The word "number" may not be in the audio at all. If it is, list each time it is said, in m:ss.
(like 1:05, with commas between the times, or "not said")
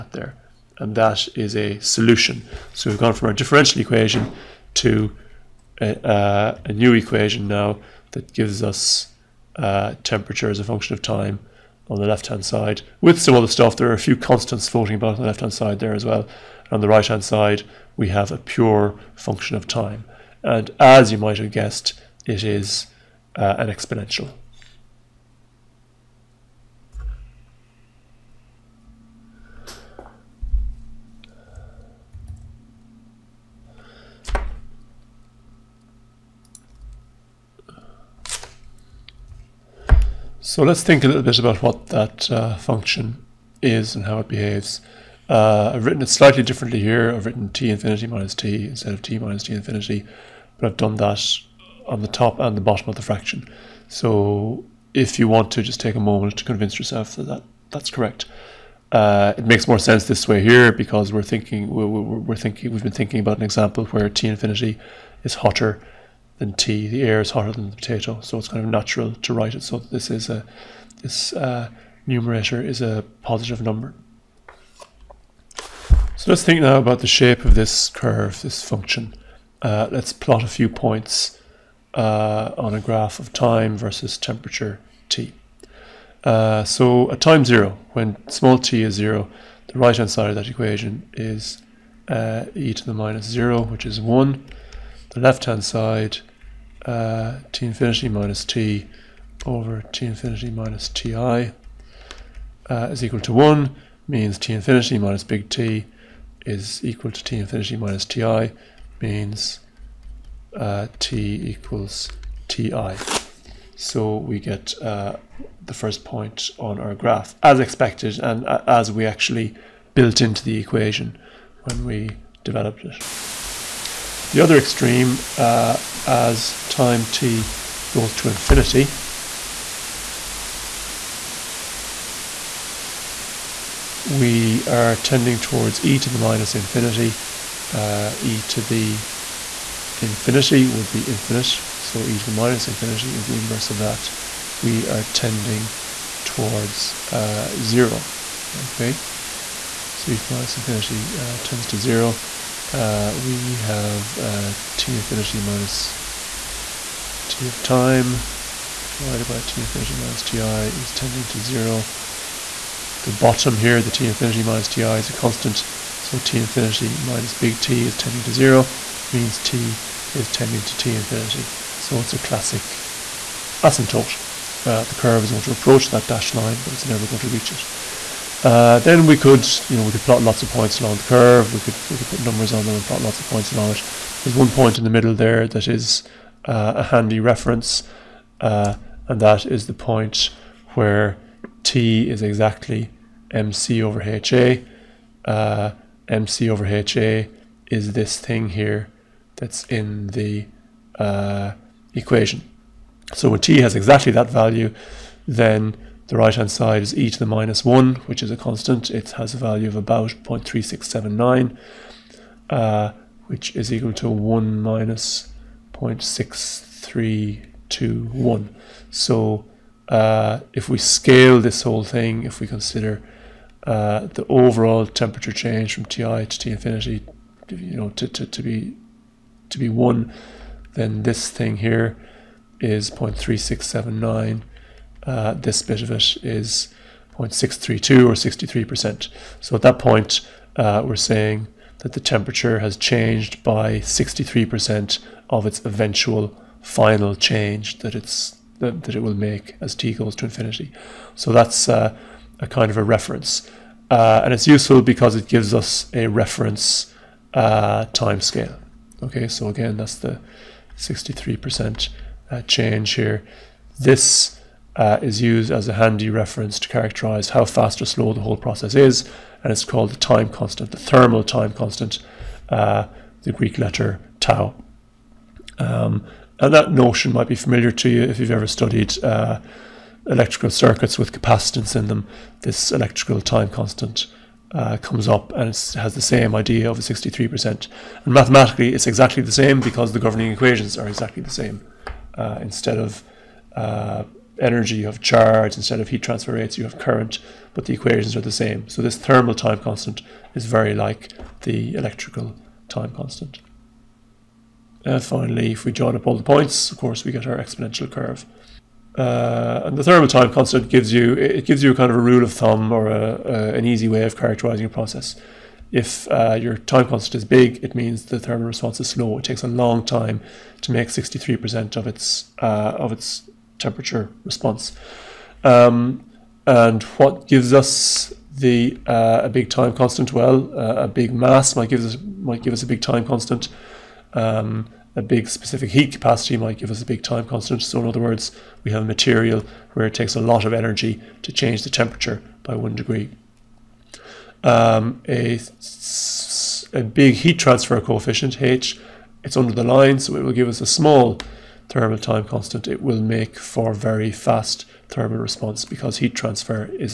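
1:13, 3:02.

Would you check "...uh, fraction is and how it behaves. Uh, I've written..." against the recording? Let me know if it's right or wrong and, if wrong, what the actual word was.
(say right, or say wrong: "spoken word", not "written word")
wrong: "function", not "fraction".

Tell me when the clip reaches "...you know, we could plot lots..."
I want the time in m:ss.
2:59.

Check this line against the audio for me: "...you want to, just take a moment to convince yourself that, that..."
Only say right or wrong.
right.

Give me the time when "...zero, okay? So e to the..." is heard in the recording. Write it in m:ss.
2:27.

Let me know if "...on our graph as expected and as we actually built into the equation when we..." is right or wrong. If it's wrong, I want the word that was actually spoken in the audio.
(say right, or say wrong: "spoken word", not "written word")
right.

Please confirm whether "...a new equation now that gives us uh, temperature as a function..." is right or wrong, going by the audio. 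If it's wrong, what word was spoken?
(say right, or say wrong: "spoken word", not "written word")
right.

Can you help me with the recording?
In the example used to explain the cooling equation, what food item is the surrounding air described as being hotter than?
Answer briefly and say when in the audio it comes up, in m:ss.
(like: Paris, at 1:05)
potato, at 1:07.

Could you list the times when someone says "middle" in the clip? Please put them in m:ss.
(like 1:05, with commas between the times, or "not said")
3:04.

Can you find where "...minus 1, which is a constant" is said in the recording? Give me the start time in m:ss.
3:27.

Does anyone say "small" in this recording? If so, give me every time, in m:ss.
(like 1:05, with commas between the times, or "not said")
1:28, 5:50.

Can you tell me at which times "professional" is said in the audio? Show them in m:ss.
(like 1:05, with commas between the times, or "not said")
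not said.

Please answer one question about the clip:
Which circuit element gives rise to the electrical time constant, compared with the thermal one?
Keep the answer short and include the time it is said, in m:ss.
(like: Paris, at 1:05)
capacitance, at 4:41.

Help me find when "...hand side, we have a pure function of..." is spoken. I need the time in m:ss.
0:17.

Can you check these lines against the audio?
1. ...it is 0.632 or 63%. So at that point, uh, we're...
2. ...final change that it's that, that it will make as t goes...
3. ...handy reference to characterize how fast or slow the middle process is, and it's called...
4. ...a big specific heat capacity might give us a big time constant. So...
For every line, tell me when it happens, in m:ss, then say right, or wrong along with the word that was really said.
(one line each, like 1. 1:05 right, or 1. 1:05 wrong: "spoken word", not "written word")
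1. 3:55 right
2. 4:06 right
3. 4:25 wrong: "whole", not "middle"
4. 5:34 right.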